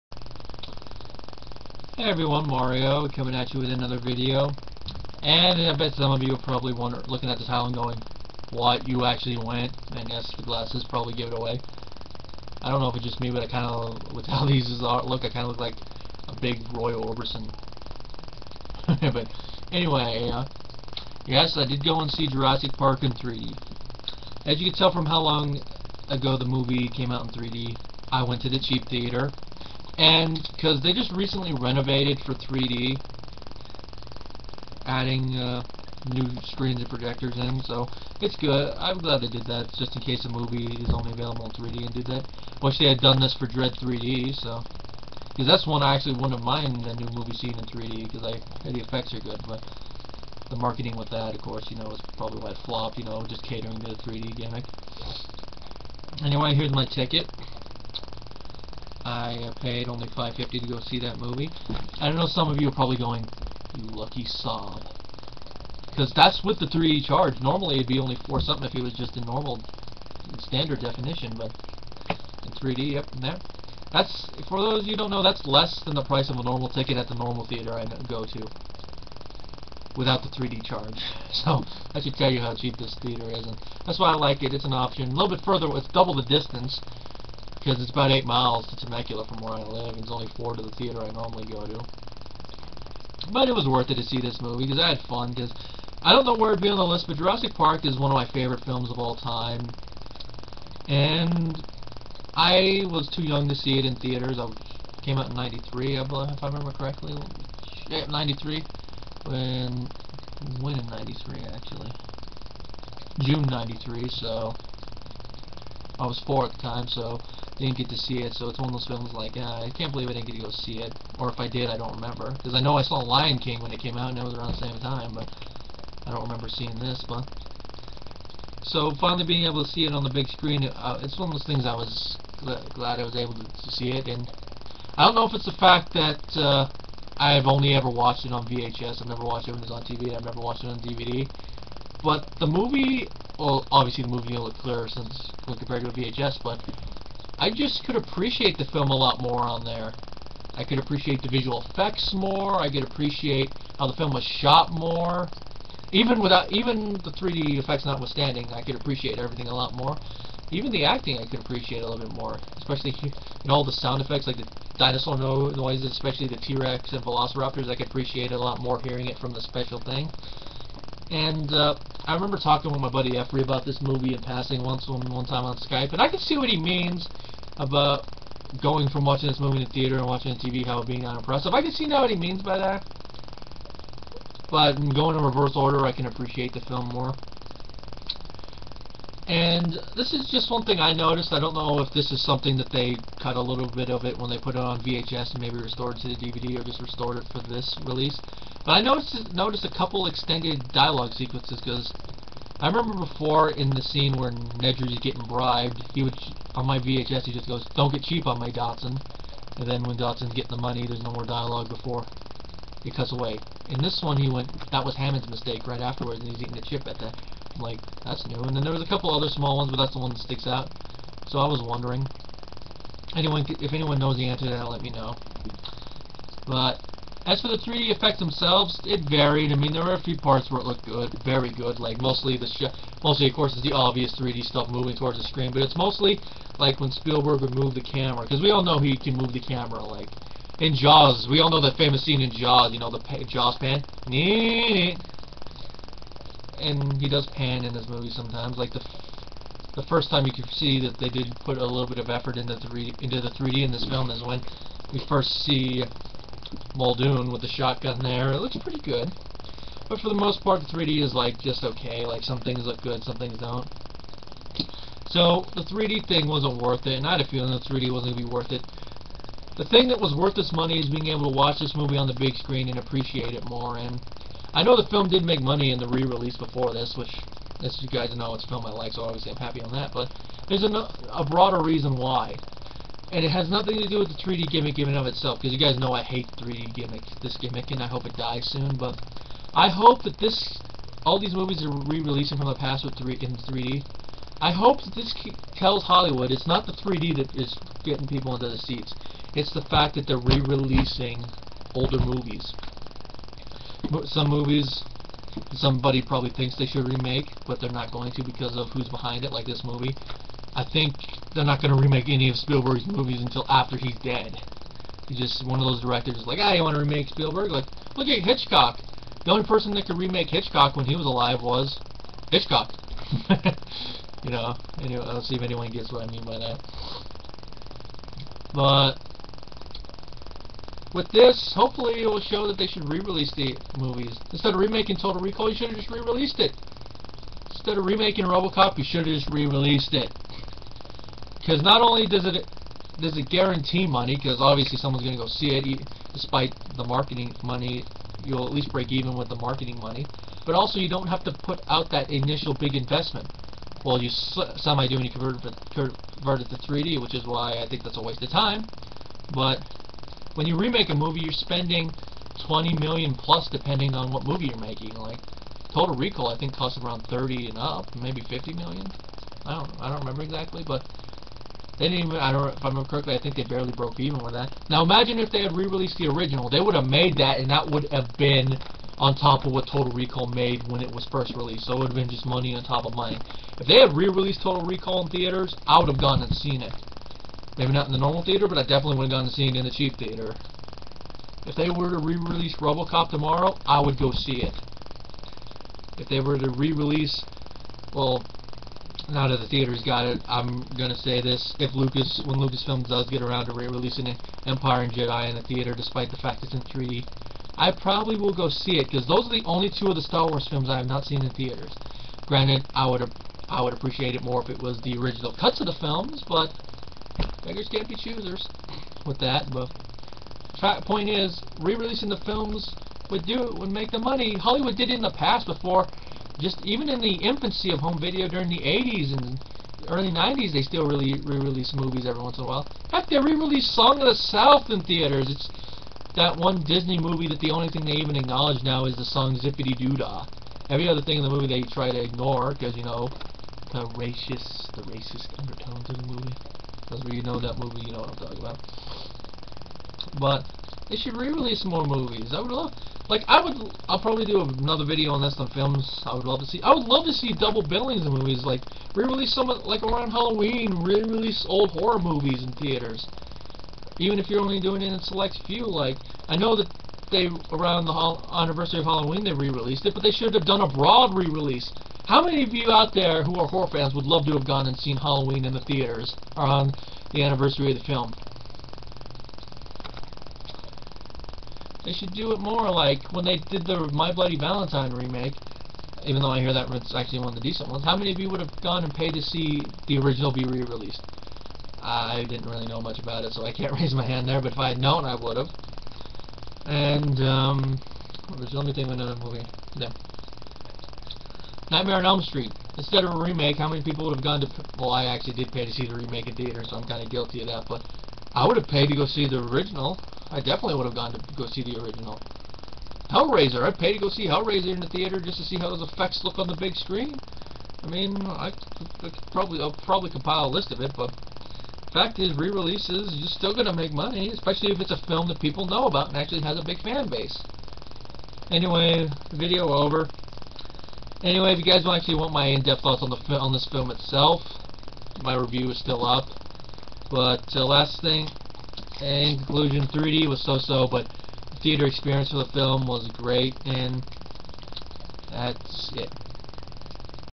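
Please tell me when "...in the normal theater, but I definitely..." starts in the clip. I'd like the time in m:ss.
6:27.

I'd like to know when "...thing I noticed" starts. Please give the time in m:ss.
3:10.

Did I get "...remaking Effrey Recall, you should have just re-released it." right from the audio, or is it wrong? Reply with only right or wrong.
wrong.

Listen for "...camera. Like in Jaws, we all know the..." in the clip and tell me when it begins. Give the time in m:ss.
3:59.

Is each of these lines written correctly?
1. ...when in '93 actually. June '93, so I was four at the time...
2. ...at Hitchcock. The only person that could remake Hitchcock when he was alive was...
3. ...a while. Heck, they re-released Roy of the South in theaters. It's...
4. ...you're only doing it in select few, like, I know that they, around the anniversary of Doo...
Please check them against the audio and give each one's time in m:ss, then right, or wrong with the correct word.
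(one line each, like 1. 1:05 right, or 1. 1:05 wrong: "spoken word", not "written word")
1. 1:50 right
2. 5:18 right
3. 7:12 wrong: "Song", not "Roy"
4. 7:44 wrong: "Halloween", not "Doo".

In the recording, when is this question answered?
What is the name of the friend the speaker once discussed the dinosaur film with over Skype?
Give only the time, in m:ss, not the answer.
2:53.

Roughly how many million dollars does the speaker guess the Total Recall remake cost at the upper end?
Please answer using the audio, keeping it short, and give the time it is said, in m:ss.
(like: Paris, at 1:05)
50 million, at 6:08.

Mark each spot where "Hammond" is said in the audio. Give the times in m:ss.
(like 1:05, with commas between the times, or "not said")
3:34.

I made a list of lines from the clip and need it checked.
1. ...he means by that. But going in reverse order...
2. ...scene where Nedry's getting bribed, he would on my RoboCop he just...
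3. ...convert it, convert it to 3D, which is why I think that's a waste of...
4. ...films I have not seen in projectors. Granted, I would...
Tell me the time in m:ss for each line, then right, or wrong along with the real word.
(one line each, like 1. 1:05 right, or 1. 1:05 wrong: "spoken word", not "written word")
1. 3:02 right
2. 3:23 wrong: "VHS", not "RoboCop"
3. 5:55 right
4. 6:50 wrong: "theaters", not "projectors".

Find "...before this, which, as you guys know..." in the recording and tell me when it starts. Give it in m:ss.
4:36.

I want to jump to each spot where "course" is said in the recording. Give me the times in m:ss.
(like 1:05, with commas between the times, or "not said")
0:51, 3:53.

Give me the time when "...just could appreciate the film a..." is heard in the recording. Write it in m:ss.
2:27.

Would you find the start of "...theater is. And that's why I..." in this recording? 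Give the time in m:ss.
1:22.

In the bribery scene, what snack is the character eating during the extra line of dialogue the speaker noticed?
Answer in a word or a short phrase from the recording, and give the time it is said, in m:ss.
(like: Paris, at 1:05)
A chip, at 3:36.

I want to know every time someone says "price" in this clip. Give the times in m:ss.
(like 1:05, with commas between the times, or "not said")
1:16.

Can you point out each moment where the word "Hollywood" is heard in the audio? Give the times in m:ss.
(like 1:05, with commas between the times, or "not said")
4:55, 7:04.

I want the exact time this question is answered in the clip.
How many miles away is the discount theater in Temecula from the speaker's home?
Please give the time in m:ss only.
1:28.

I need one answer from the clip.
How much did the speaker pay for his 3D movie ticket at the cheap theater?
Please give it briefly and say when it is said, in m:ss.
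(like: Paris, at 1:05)
$5.50, at 1:00.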